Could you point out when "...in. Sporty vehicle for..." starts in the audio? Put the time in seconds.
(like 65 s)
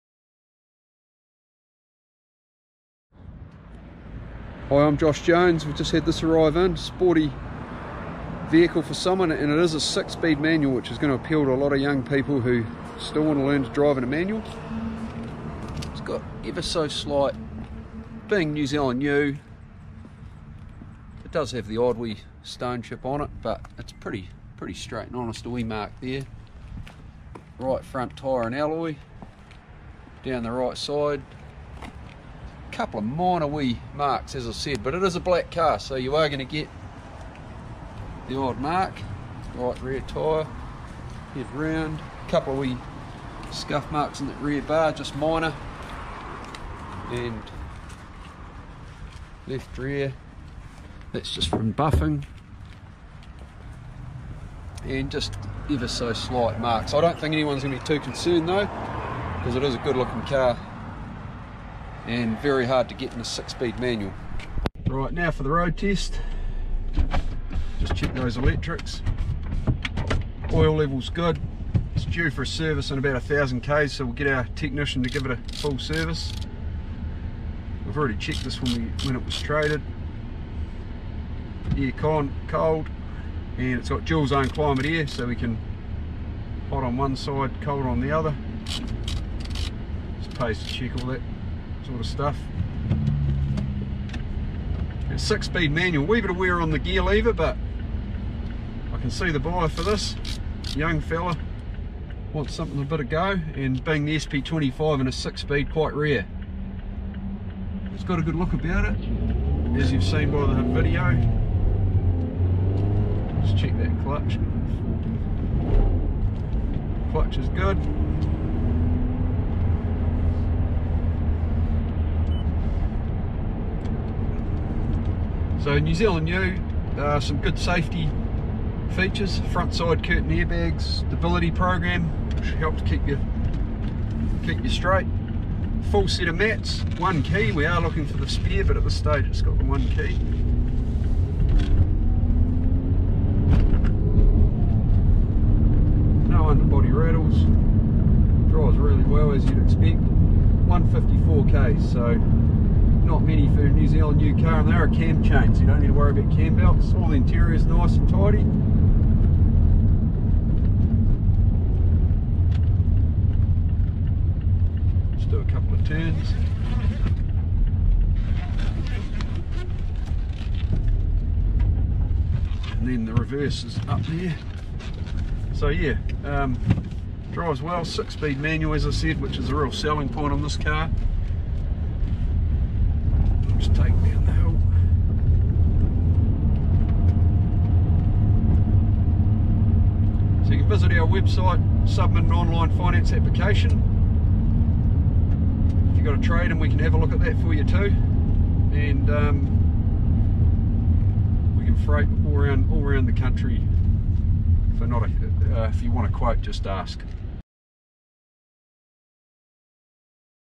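6 s.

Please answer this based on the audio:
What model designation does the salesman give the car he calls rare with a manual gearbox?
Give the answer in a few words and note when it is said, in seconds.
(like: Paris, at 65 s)
SP25, at 104 s.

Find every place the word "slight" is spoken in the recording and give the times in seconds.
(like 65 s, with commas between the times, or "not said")
16 s, 56 s.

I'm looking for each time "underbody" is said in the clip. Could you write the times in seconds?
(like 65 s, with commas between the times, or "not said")
146 s.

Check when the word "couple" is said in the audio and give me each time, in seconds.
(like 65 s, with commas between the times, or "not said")
32 s, 42 s, 165 s.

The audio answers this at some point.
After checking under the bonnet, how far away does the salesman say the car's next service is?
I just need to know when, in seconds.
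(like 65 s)
72 s.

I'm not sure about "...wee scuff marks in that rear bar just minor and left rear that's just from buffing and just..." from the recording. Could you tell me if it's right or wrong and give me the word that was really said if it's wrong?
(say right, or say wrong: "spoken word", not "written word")
right.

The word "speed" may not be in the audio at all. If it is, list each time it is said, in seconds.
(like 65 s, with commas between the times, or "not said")
9 s, 63 s, 95 s, 105 s, 177 s.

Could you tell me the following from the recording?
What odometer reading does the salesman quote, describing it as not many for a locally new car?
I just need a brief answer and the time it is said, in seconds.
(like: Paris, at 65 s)
154k, at 150 s.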